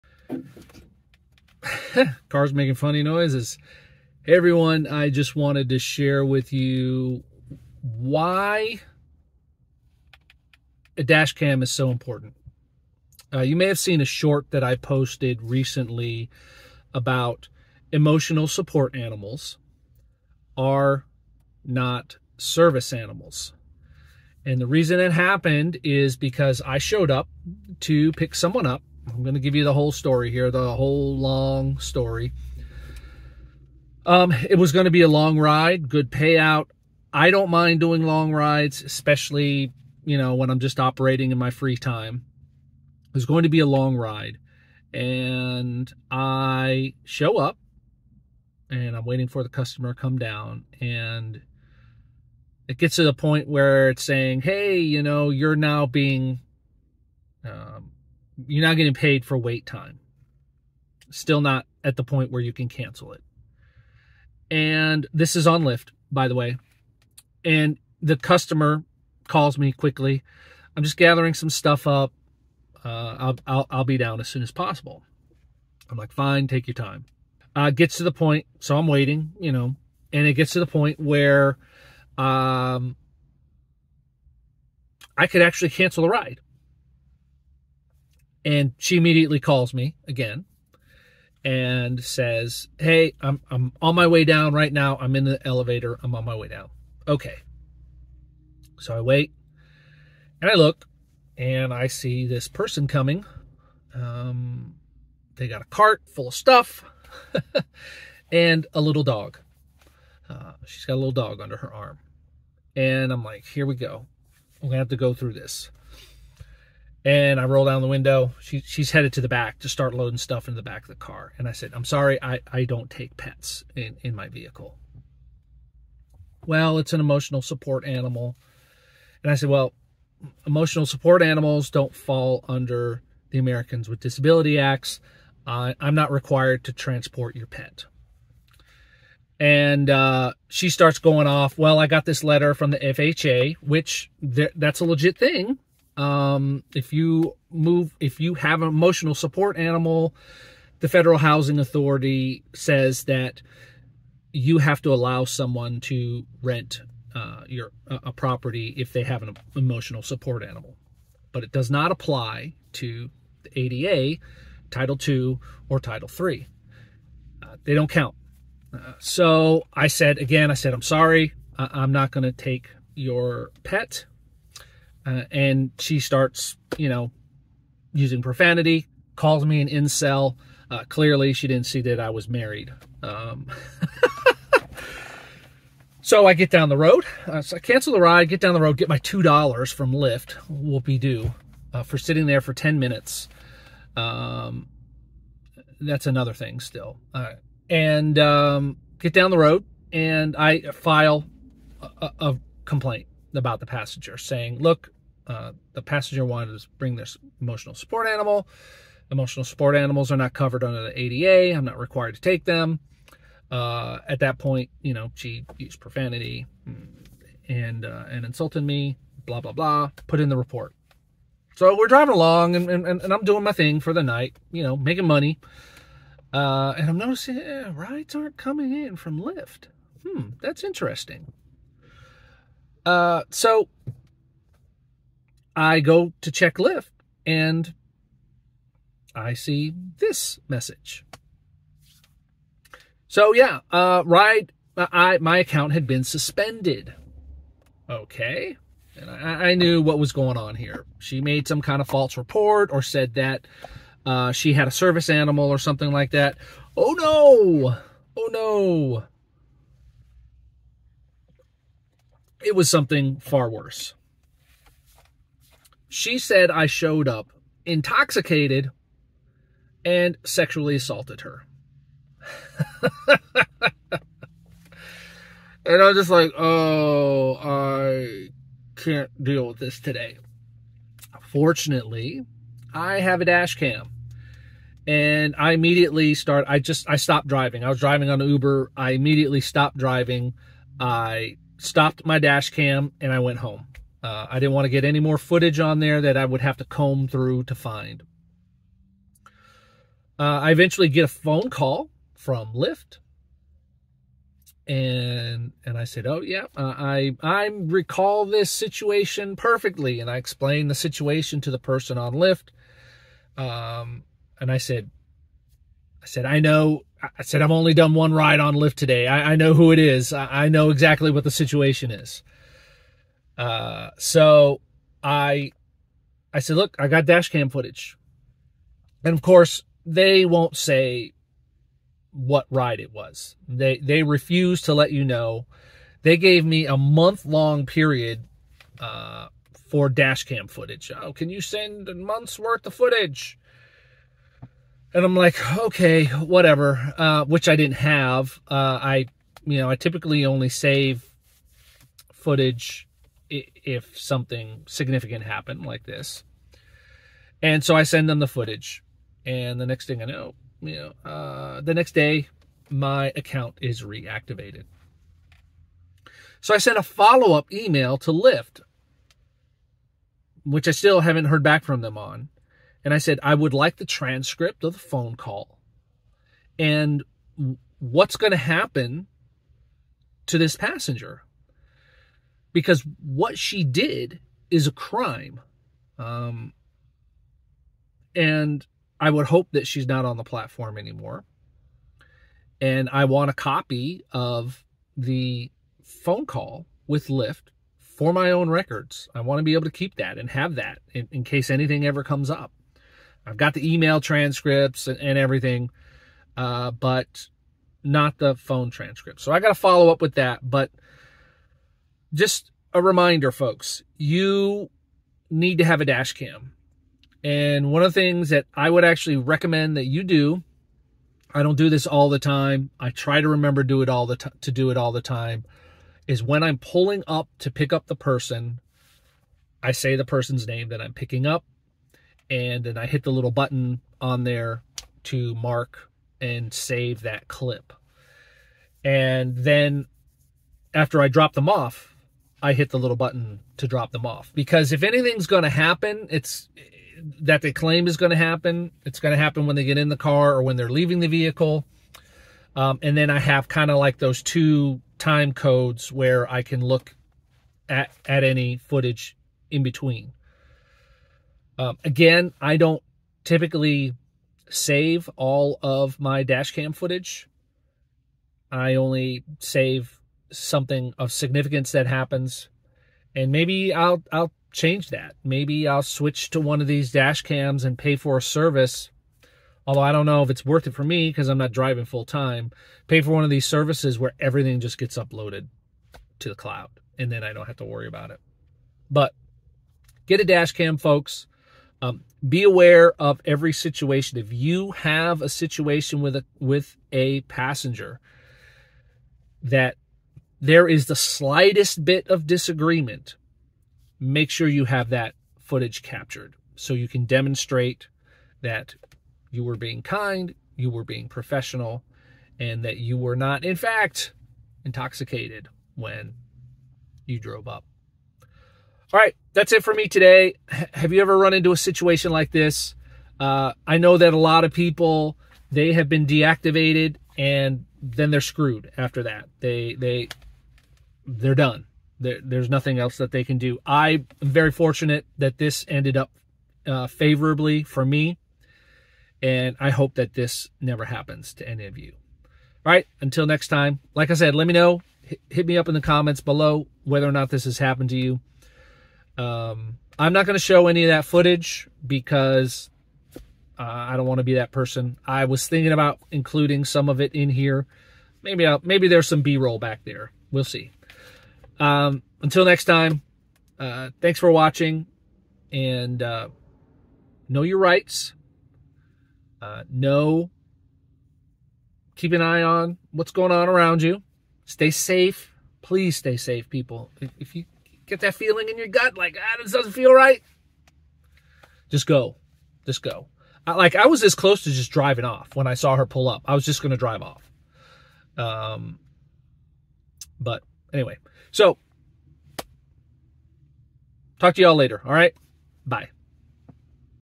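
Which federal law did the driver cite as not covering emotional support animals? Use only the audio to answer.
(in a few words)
Americans with Disability Acts.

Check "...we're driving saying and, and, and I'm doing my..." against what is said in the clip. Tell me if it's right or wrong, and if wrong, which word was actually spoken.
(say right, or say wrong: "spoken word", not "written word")
wrong: "along", not "saying".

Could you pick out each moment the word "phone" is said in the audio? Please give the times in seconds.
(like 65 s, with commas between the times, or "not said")
301 s, 374 s, 395 s, 408 s.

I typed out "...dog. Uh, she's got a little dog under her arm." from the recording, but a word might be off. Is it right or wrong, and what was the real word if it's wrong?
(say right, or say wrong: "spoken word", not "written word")
right.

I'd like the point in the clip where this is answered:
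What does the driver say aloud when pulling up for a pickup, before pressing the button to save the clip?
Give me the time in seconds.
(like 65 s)
429 s.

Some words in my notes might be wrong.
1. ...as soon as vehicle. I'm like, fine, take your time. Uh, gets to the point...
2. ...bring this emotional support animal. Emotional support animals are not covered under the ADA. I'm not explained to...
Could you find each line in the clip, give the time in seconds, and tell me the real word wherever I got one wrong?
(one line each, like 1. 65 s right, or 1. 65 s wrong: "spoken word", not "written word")
1. 74 s wrong: "possible", not "vehicle"
2. 206 s wrong: "required", not "explained".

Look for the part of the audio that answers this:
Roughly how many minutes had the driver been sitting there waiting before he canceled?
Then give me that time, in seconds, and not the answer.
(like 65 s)
192 s.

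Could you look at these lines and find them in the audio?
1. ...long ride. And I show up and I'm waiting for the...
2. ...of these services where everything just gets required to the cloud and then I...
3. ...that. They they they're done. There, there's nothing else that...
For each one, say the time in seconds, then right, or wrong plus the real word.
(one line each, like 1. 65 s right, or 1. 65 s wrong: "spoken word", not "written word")
1. 43 s right
2. 483 s wrong: "uploaded", not "required"
3. 529 s right.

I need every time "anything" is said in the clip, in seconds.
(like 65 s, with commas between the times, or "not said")
401 s, 444 s.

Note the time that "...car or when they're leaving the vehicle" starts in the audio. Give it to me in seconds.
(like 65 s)
449 s.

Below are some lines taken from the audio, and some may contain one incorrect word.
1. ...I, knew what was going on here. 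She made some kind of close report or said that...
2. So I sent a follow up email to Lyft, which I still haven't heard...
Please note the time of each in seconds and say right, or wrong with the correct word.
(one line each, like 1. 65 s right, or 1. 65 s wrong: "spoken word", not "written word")
1. 249 s wrong: "false", not "close"
2. 366 s right.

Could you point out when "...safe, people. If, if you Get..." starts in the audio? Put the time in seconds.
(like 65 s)
576 s.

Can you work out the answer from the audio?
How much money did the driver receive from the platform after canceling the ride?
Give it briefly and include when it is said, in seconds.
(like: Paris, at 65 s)
$2, at 188 s.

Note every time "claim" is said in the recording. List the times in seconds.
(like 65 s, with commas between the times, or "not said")
447 s.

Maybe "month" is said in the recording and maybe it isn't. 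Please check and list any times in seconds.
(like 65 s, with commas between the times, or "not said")
336 s, 341 s.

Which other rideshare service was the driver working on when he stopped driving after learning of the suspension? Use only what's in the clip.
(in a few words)
Uber.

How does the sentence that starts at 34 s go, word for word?
Um, it was going to be a long ride, good payout.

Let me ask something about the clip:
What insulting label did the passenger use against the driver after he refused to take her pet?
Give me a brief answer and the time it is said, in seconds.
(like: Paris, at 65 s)
Incel, at 179 s.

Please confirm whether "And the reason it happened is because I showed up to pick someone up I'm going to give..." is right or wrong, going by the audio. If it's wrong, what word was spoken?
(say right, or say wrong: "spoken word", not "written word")
right.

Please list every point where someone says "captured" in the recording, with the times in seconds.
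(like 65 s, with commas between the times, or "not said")
505 s.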